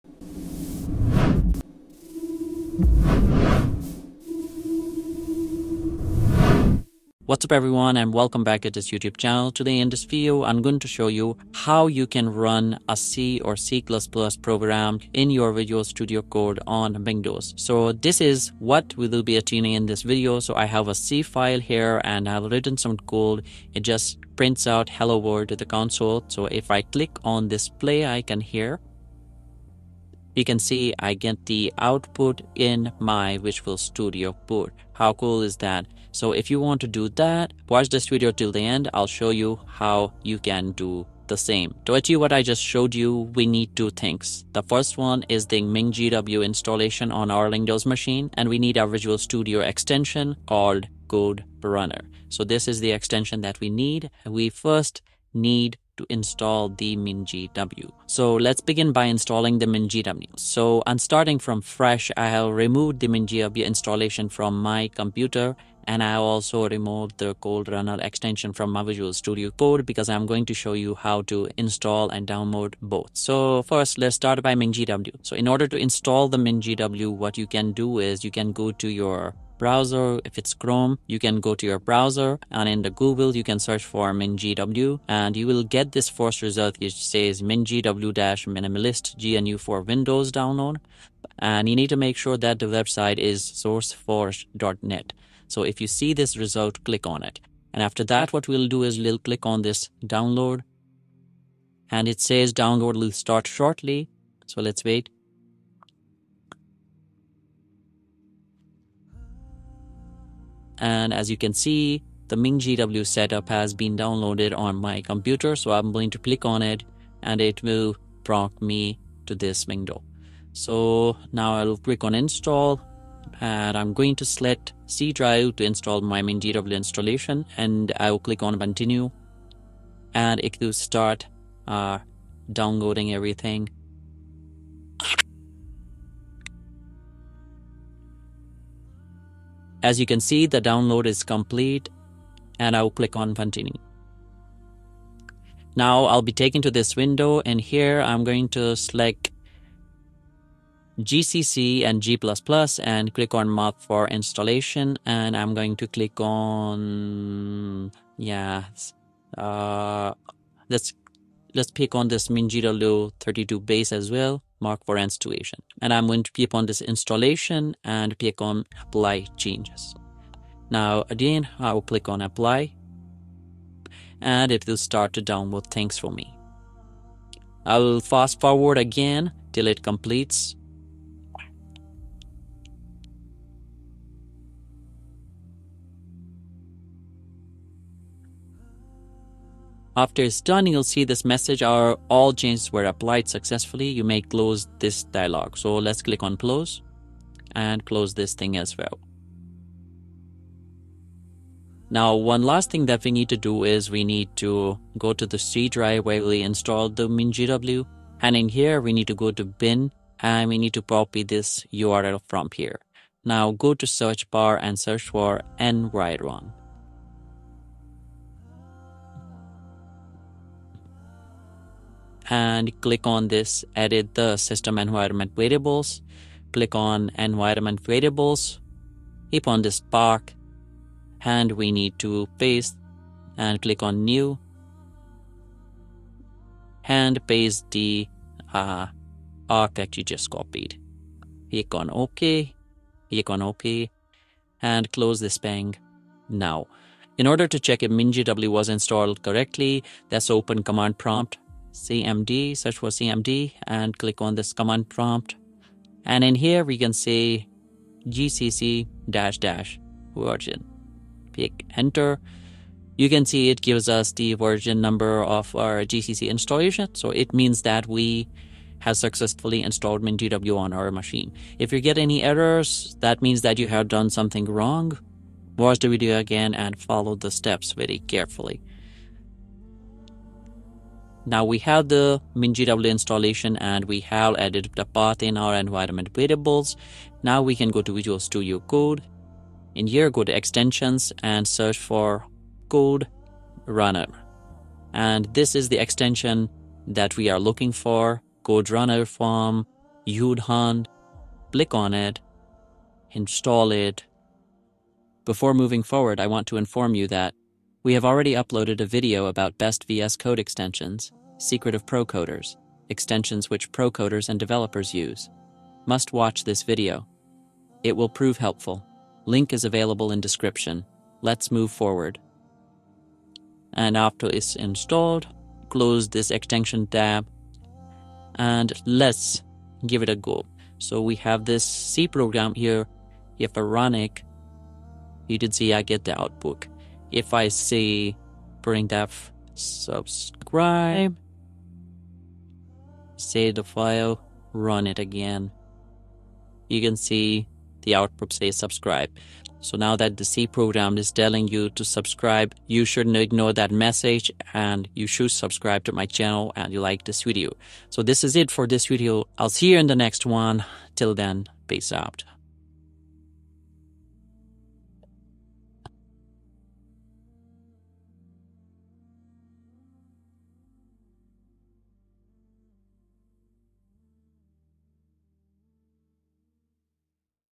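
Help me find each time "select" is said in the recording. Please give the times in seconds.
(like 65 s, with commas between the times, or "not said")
124 s, 148 s.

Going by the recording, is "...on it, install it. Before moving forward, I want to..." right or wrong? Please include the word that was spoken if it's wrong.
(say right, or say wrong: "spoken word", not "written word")
right.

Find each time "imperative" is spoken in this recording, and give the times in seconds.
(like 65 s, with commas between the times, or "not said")
not said.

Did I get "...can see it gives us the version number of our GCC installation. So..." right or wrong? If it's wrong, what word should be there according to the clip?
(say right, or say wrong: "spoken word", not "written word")
right.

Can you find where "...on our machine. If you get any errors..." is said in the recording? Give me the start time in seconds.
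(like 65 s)
270 s.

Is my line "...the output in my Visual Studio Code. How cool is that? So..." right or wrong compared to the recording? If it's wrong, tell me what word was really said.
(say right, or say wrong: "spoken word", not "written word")
right.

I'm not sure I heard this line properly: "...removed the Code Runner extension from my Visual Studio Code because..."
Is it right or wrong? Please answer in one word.
right.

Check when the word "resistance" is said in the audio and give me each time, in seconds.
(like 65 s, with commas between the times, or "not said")
not said.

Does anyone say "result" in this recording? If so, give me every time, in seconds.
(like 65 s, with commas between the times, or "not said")
86 s, 96 s.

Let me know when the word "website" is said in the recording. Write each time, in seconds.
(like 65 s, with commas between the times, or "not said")
92 s.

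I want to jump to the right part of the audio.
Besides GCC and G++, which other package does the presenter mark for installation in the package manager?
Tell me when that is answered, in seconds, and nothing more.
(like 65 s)
162 s.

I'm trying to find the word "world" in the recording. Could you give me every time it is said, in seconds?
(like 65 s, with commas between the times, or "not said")
25 s.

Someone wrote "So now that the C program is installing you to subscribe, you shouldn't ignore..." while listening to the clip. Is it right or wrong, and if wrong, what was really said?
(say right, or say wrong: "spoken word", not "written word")
wrong: "telling", not "installing".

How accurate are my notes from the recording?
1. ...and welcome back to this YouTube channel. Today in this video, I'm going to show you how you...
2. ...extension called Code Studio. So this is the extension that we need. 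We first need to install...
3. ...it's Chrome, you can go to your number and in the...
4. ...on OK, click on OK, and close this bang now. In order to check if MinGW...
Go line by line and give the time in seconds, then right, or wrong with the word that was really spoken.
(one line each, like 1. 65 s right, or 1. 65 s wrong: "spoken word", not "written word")
1. 7 s right
2. 49 s wrong: "Runner", not "Studio"
3. 80 s wrong: "browser", not "number"
4. 241 s right.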